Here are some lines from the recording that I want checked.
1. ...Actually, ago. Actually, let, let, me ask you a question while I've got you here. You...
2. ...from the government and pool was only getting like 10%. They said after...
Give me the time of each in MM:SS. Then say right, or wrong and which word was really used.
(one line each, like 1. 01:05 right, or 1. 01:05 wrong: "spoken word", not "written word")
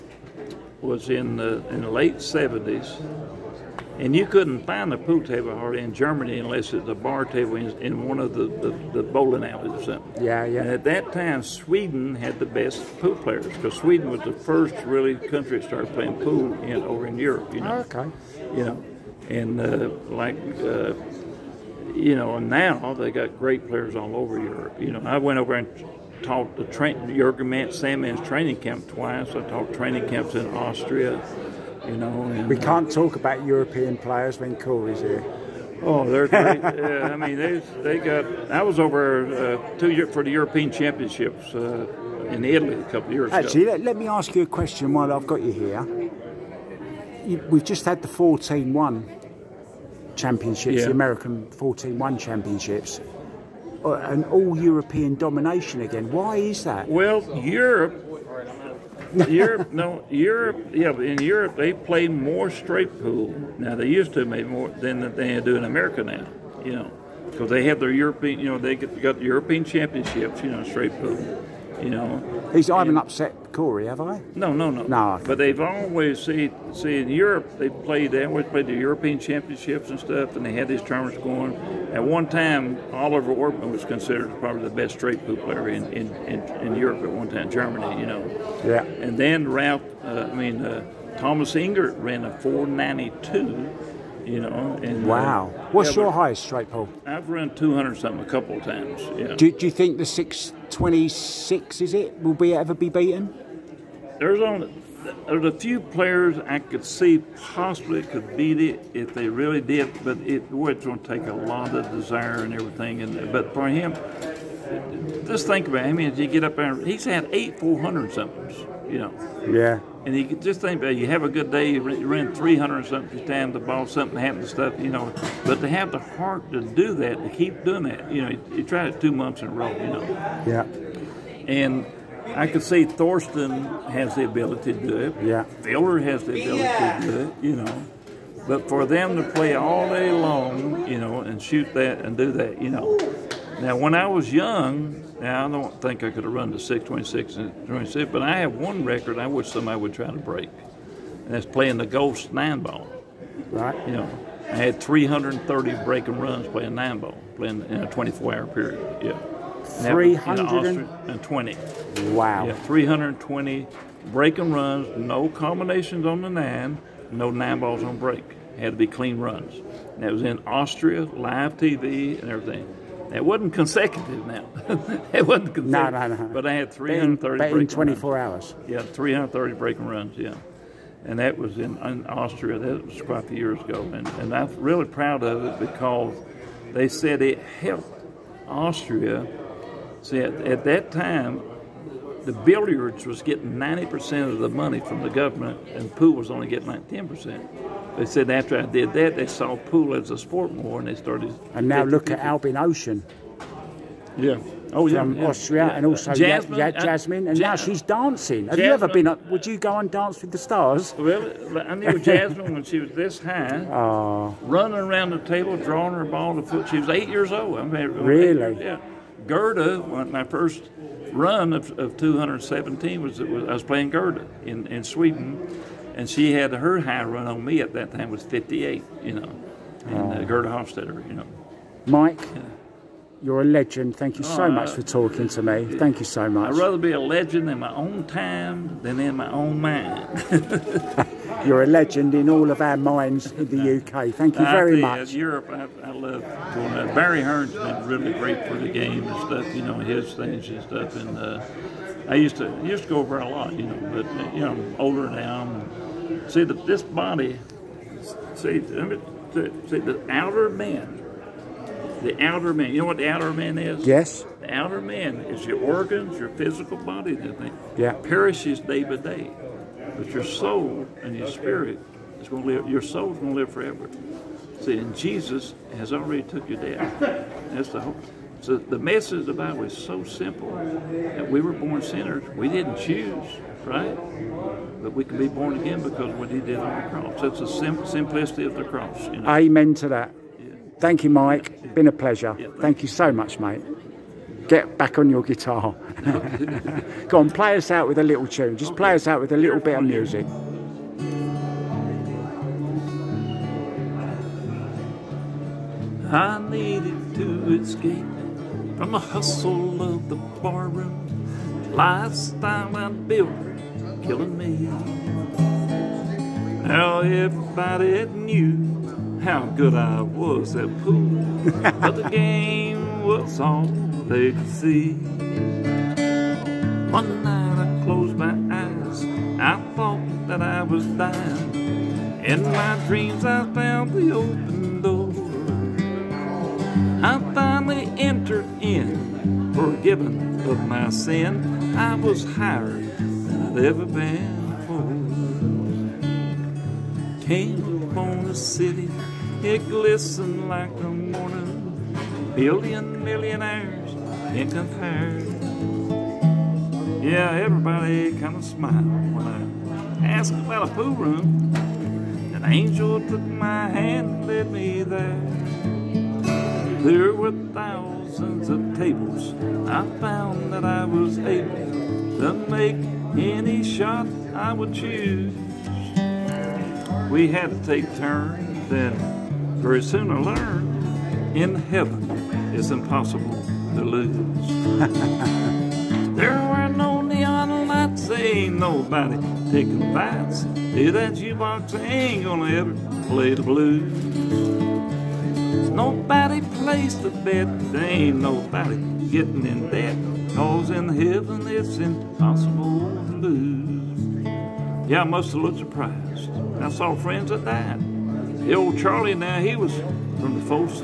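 1. 00:43 right
2. 03:14 right.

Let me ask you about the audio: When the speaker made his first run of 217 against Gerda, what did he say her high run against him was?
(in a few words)
58.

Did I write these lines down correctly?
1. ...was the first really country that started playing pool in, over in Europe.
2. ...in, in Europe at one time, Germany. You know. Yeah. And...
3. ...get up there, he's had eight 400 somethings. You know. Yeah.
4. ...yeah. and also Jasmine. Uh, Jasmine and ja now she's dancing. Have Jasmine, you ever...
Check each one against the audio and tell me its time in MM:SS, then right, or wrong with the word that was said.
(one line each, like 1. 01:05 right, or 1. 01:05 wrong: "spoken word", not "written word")
1. 00:14 right
2. 01:26 right
3. 01:56 right
4. 03:25 right.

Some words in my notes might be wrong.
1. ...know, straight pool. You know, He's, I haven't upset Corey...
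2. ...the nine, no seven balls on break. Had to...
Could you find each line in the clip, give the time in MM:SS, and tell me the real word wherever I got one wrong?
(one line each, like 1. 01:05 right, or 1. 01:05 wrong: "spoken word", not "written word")
1. 01:10 right
2. 02:46 wrong: "nine", not "seven".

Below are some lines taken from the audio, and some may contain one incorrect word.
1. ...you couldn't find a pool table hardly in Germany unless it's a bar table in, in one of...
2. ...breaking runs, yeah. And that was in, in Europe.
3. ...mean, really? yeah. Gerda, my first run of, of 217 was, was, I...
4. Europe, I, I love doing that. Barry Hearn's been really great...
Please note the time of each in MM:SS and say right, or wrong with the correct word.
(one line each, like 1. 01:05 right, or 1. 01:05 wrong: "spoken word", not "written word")
1. 00:04 right
2. 02:59 wrong: "Austria", not "Europe"
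3. 03:37 right
4. 04:05 right.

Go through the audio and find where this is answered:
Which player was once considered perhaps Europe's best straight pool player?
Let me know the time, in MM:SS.
01:22.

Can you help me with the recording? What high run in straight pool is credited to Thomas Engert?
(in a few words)
492.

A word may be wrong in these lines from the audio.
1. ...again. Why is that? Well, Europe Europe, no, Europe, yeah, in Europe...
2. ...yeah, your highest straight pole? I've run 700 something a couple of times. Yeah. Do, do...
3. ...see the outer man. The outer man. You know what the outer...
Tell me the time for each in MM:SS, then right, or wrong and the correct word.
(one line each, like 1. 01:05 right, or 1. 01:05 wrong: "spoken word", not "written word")
1. 00:55 right
2. 01:35 wrong: "200", not "700"
3. 04:18 right.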